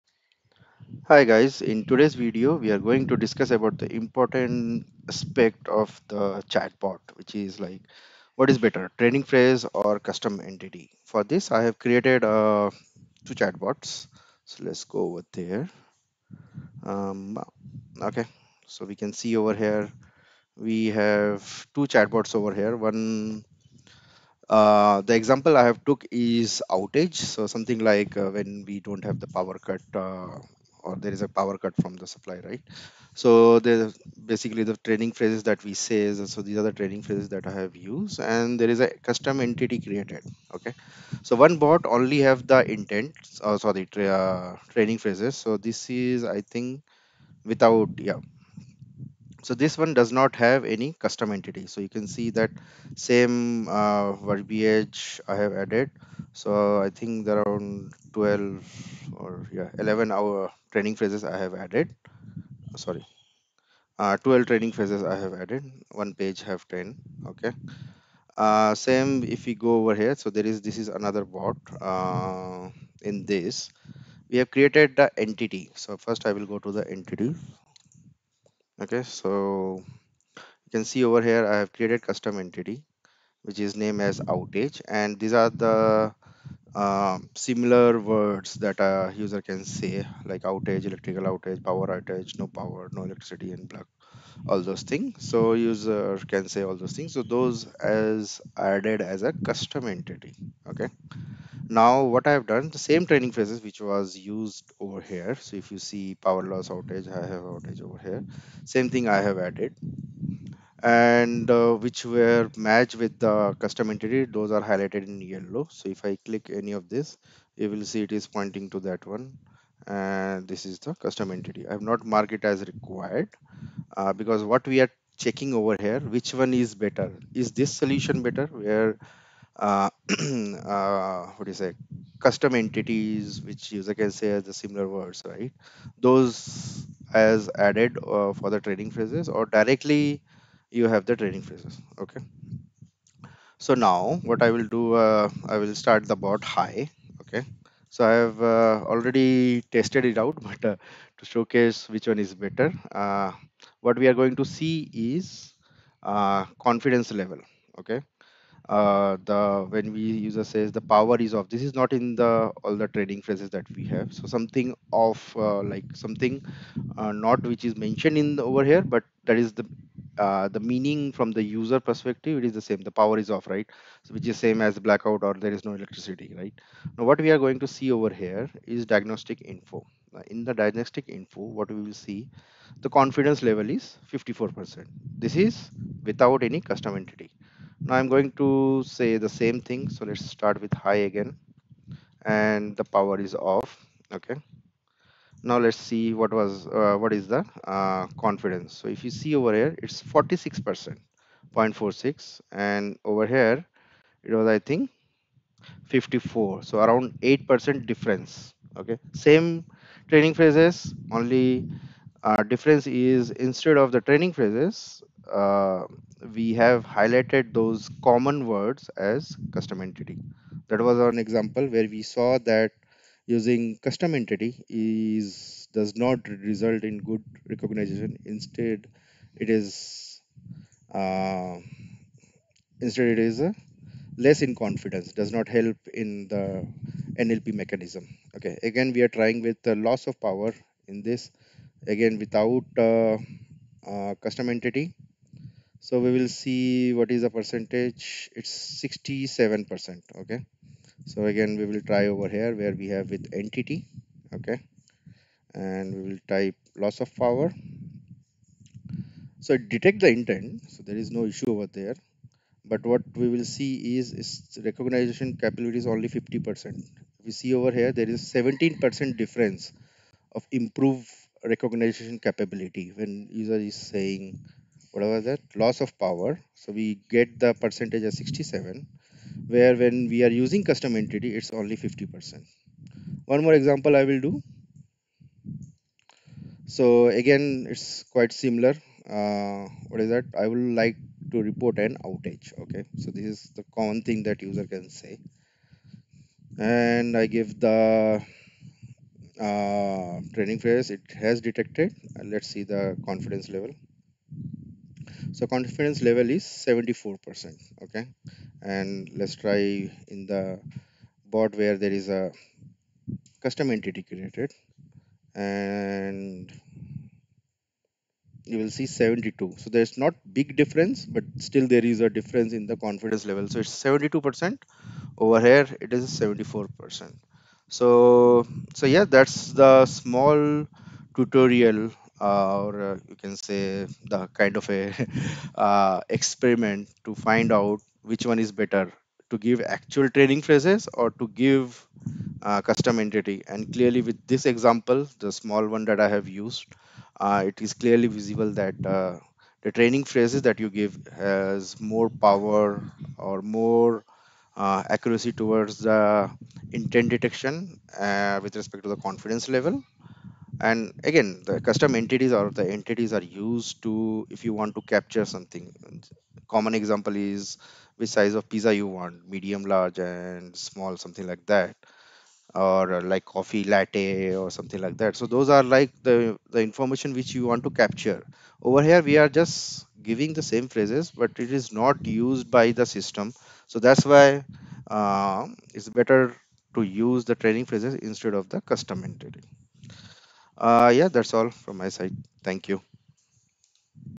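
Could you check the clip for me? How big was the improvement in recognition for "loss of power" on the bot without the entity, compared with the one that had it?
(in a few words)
17 percent.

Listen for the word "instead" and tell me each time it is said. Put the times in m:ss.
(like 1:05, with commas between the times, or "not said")
3:33, 3:48, 3:52, 6:28.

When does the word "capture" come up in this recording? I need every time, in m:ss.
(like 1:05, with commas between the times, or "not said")
6:04, 6:17.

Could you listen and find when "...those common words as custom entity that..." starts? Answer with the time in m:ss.
3:37.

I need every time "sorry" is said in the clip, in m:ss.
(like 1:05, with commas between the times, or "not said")
0:43, 1:02.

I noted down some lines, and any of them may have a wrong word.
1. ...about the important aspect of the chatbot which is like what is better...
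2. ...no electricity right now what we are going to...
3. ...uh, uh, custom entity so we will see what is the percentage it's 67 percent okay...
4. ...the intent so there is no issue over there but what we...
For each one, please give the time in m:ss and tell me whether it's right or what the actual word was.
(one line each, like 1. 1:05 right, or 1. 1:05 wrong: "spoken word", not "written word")
1. 0:03 right
2. 2:55 right
3. 4:02 right
4. 4:20 right.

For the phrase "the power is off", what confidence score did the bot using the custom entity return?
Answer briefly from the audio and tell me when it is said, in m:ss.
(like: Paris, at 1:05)
0.46, at 3:21.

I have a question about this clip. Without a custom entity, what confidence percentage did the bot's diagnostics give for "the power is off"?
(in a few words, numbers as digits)
54 percent.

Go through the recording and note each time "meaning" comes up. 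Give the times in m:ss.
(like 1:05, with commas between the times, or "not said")
2:50.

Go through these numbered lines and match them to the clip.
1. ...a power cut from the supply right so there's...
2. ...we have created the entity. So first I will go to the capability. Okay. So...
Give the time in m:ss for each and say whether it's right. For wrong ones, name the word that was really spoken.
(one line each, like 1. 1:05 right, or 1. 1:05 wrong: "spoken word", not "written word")
1. 0:31 right
2. 1:14 wrong: "entity", not "capability".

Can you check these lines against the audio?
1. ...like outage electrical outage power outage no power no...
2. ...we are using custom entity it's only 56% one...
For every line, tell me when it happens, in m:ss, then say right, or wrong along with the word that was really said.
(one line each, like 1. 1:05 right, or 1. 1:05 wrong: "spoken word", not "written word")
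1. 1:30 right
2. 4:40 wrong: "50", not "56".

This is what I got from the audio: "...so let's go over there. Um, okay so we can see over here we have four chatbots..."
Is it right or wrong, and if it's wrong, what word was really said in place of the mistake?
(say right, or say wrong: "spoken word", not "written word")
wrong: "two", not "four".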